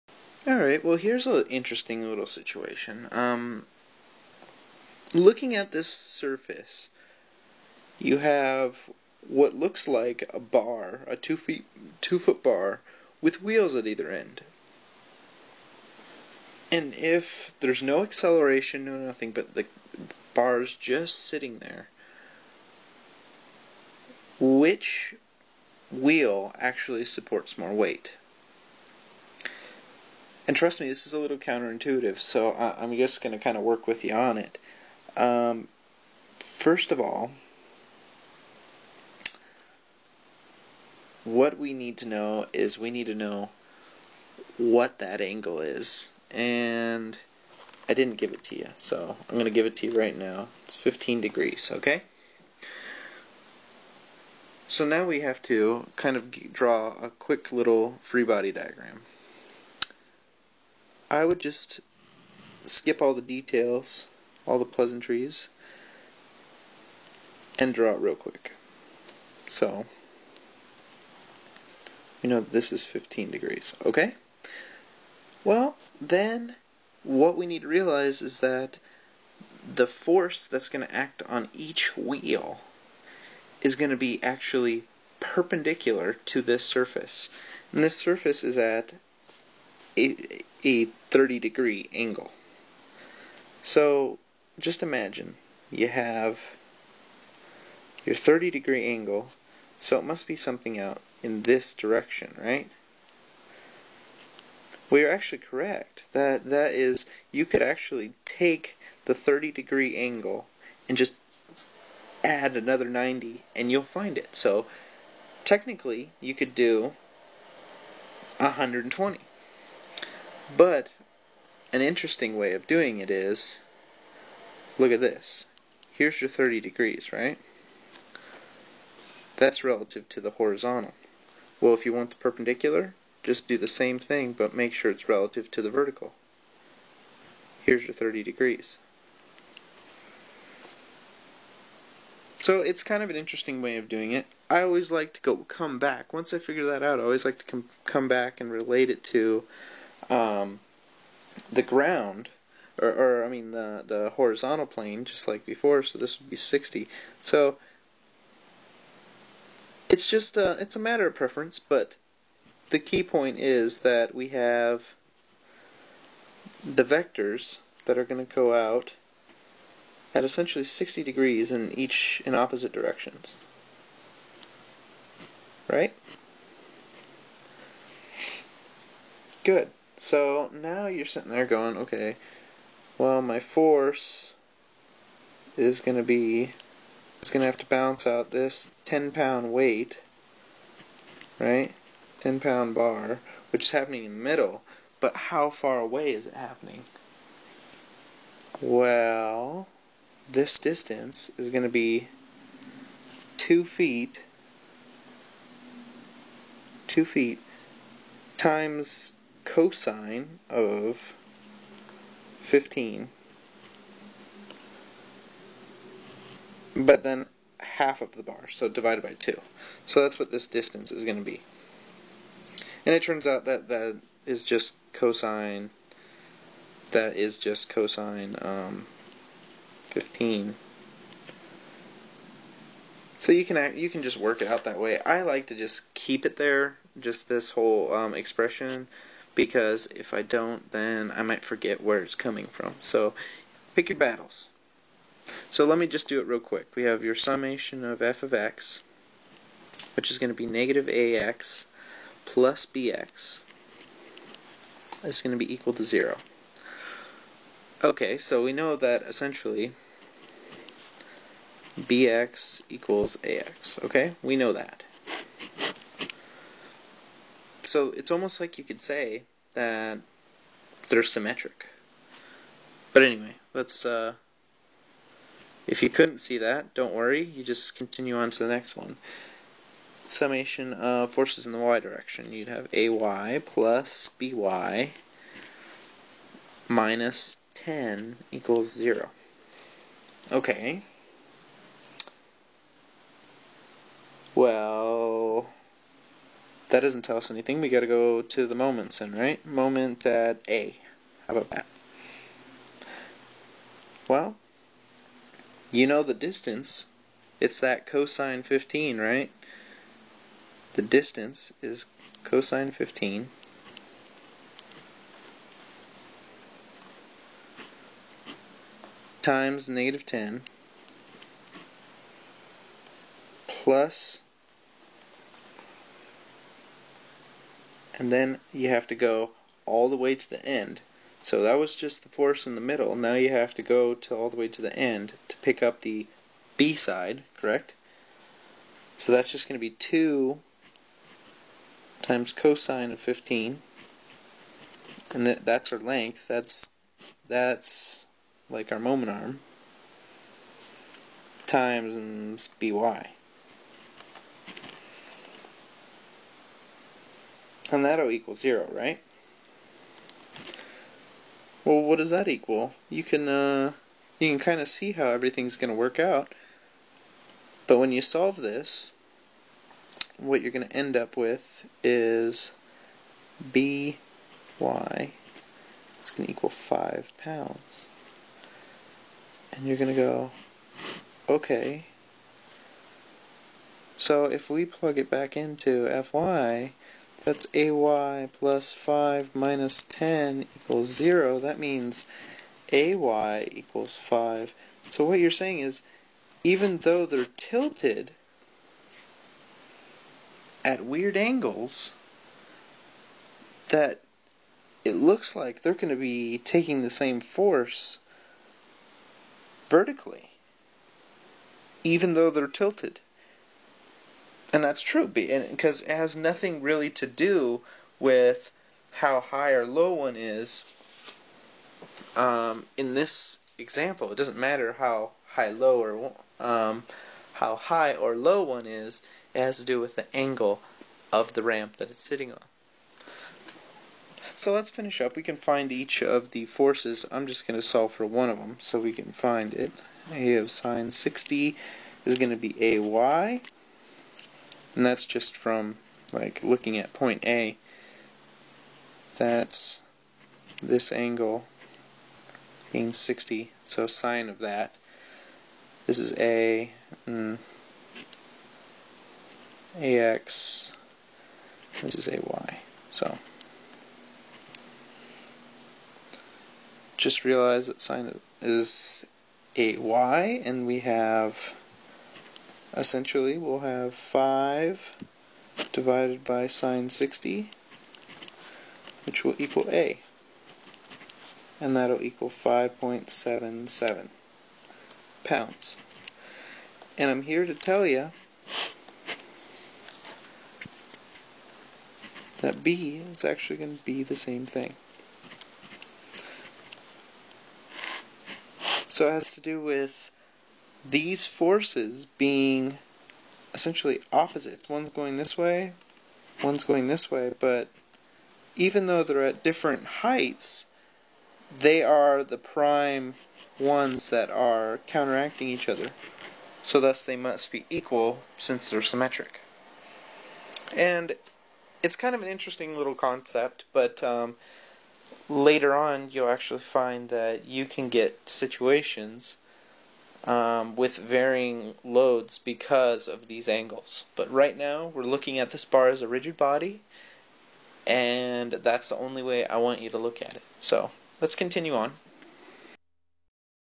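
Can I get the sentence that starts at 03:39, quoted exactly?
So that's what this distance is going to be.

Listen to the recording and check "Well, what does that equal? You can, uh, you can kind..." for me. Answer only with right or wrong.
right.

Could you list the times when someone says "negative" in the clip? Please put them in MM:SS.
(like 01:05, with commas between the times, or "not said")
04:10, 05:19.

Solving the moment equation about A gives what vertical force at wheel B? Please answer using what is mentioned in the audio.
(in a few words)
5 pounds.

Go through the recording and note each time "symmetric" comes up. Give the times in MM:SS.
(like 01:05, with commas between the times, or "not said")
04:31, 08:38.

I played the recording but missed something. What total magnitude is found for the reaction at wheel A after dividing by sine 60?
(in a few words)
5.77 pounds.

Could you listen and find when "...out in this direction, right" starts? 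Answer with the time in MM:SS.
01:40.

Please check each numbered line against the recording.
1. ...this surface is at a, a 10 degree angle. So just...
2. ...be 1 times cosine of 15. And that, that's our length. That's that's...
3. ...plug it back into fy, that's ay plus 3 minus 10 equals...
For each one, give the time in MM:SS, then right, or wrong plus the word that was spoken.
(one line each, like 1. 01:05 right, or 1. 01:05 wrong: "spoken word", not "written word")
1. 01:27 wrong: "30", not "10"
2. 05:39 wrong: "2", not "1"
3. 06:24 wrong: "5", not "3".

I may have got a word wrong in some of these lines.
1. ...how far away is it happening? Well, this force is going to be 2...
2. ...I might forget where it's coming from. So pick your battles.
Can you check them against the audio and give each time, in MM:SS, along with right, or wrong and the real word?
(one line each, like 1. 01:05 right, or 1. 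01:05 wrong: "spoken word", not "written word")
1. 03:15 wrong: "distance", not "force"
2. 04:01 right.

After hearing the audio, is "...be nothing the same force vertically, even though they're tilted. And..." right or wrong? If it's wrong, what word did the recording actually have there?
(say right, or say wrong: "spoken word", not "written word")
wrong: "taking", not "nothing".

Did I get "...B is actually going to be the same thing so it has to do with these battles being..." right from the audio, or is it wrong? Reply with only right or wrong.
wrong.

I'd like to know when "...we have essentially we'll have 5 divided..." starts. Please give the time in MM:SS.
07:50.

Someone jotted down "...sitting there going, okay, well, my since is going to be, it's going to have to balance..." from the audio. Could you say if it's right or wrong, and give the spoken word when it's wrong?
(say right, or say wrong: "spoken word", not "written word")
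wrong: "force", not "since".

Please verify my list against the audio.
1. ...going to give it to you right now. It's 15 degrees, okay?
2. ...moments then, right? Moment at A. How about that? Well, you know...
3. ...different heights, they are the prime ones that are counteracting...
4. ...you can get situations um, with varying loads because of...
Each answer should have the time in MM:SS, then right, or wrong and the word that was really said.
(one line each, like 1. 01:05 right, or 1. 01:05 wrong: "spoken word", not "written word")
1. 00:49 right
2. 04:58 right
3. 08:29 right
4. 08:47 right.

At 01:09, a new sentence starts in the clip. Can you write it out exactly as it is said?
So, you know this is 15 degrees, okay?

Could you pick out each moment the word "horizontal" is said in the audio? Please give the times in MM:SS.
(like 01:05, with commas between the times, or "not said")
02:10, 02:34.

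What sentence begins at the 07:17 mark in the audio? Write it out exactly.
I'm just going to solve for one of them so we can find it.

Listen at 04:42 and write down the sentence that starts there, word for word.
You'd have ay plus by minus 10 equals 0.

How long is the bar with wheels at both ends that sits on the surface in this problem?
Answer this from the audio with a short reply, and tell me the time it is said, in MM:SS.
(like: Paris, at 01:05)
2 feet, at 00:12.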